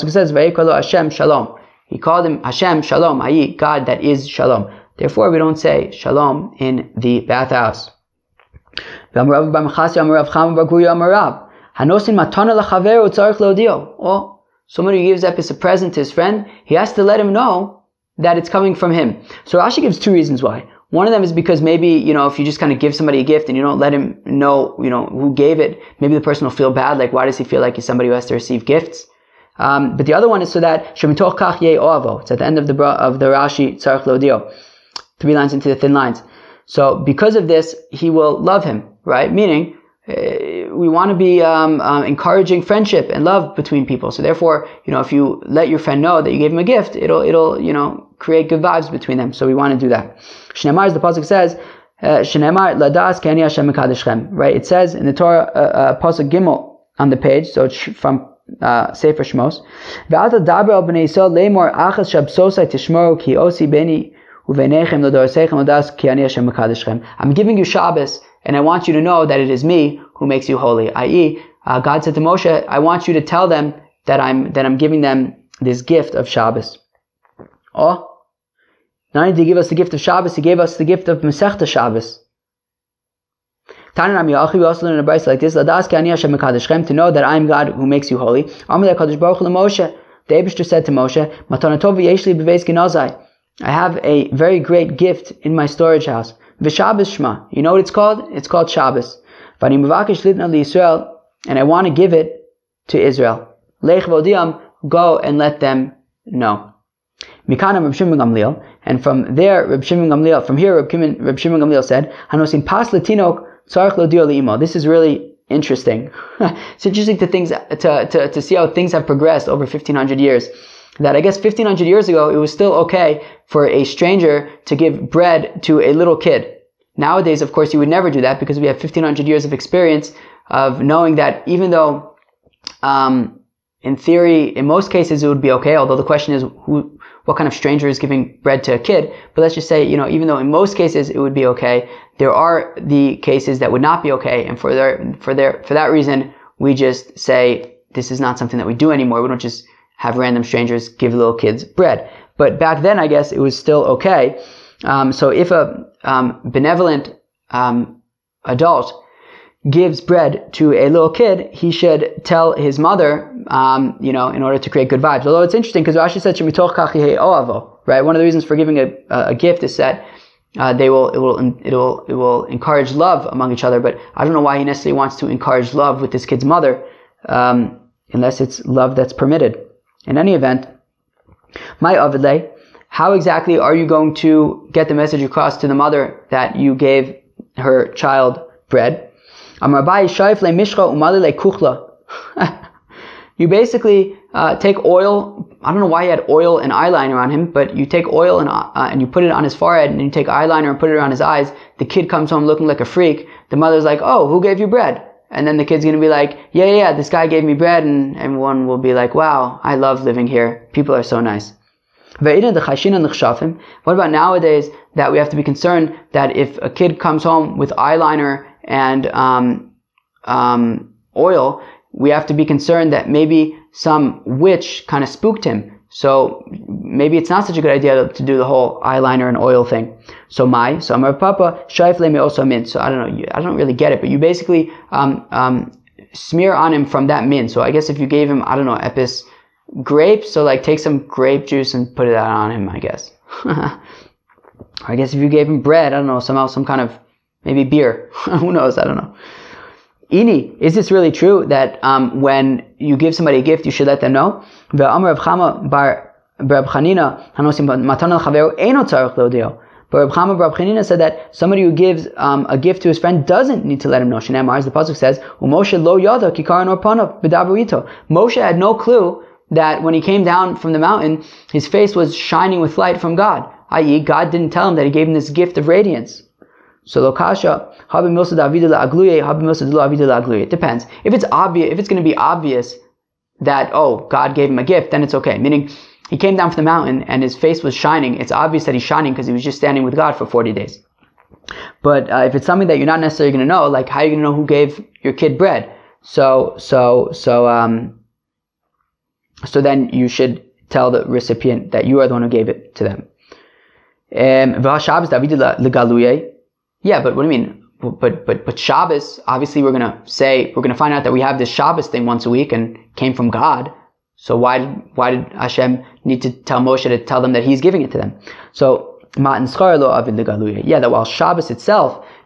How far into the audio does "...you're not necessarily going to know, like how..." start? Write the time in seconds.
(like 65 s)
292 s.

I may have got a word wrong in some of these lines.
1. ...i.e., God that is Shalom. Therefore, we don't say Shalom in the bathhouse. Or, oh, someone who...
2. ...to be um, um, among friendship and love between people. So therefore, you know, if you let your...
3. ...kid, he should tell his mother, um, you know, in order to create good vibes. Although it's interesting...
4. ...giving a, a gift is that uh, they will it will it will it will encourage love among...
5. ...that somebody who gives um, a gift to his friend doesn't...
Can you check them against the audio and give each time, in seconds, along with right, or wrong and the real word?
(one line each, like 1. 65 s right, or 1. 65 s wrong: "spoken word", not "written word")
1. 3 s right
2. 41 s wrong: "encouraging", not "among"
3. 161 s right
4. 168 s right
5. 260 s right.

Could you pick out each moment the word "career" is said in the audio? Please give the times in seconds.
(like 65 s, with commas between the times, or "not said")
not said.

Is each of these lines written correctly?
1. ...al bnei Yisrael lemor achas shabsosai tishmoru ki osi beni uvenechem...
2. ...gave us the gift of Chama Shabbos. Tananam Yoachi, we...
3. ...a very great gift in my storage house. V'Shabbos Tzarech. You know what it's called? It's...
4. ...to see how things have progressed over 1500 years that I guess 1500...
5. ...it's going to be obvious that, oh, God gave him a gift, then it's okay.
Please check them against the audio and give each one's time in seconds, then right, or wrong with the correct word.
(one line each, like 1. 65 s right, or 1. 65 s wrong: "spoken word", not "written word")
1. 60 s right
2. 80 s wrong: "Masechta", not "Chama"
3. 94 s wrong: "Shema", not "Tzarech"
4. 118 s right
5. 281 s right.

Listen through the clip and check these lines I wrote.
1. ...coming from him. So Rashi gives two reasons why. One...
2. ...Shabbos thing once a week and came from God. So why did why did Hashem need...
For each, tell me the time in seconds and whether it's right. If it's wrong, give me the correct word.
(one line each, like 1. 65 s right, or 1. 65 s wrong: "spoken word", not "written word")
1. 18 s right
2. 311 s right.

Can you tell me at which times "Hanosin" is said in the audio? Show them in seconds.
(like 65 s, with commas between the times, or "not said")
112 s.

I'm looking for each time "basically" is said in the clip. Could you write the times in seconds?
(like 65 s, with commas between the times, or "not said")
193 s, 234 s.